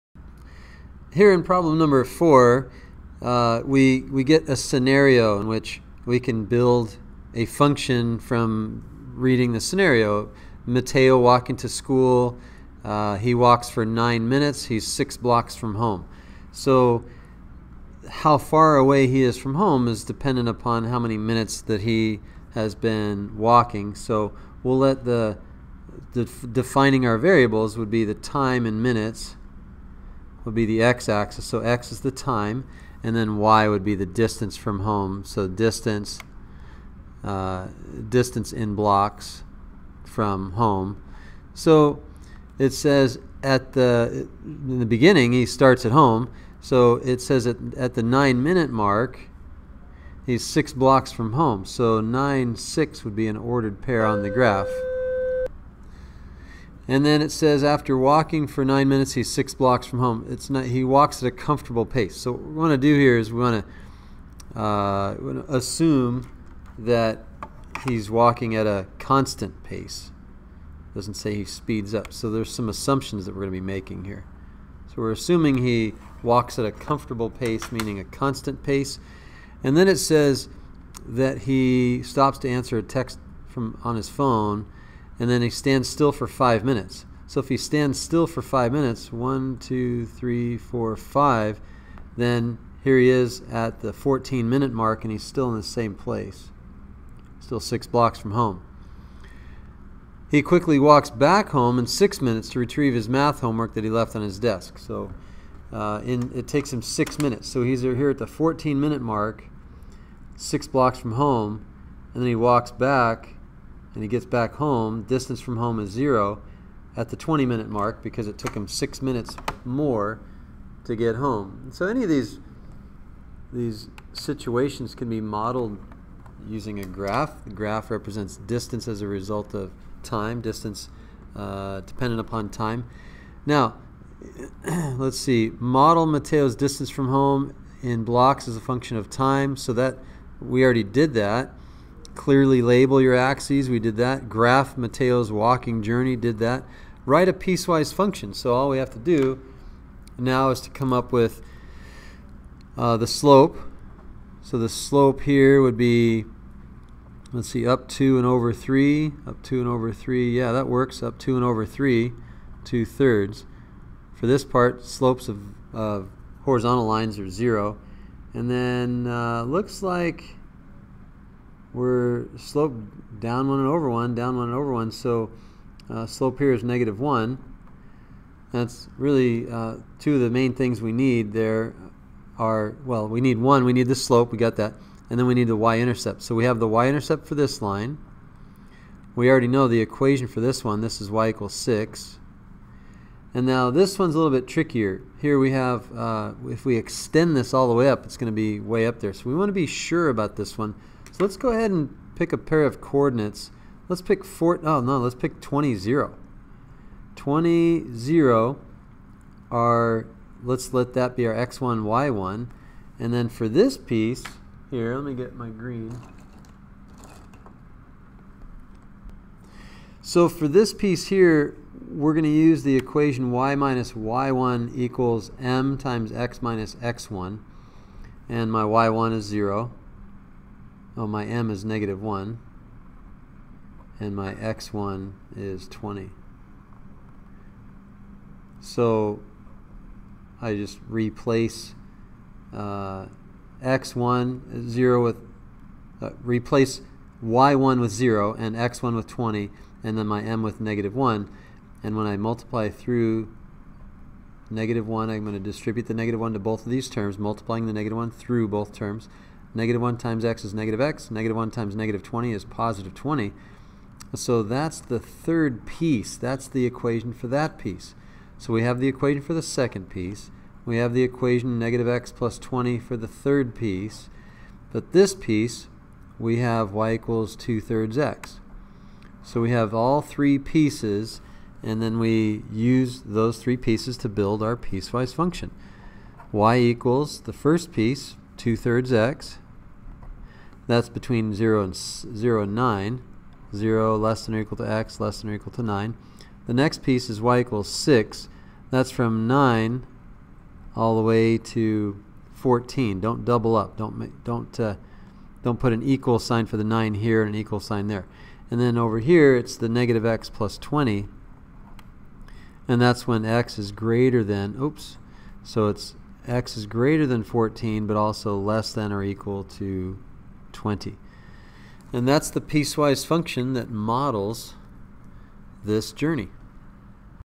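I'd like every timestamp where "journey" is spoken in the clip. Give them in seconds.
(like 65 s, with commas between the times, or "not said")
145 s, 325 s.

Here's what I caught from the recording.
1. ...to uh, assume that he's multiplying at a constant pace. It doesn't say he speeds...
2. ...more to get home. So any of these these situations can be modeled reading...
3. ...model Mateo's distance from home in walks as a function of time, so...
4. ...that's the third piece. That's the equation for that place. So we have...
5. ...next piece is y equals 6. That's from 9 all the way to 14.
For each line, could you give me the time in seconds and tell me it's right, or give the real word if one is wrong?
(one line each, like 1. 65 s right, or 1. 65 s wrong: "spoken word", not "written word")
1. 64 s wrong: "walking", not "multiplying"
2. 119 s wrong: "using", not "reading"
3. 135 s wrong: "blocks", not "walks"
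4. 264 s wrong: "piece", not "place"
5. 296 s right.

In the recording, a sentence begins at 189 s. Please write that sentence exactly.
We already know the equation for this one, this is y equals 6.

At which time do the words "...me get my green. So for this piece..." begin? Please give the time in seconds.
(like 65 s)
215 s.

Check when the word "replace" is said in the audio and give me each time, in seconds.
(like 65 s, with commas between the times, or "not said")
240 s, 246 s.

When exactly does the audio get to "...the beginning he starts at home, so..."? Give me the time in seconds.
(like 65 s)
44 s.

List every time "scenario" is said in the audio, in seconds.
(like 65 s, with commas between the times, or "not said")
4 s, 9 s.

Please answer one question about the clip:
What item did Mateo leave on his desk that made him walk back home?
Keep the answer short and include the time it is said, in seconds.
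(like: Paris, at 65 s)
math homework, at 103 s.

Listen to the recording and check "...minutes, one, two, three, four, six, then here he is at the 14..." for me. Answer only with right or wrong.
wrong.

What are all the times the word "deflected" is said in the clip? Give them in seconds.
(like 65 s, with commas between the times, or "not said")
not said.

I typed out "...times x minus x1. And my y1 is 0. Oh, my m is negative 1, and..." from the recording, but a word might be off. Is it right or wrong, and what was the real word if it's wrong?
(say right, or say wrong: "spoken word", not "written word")
right.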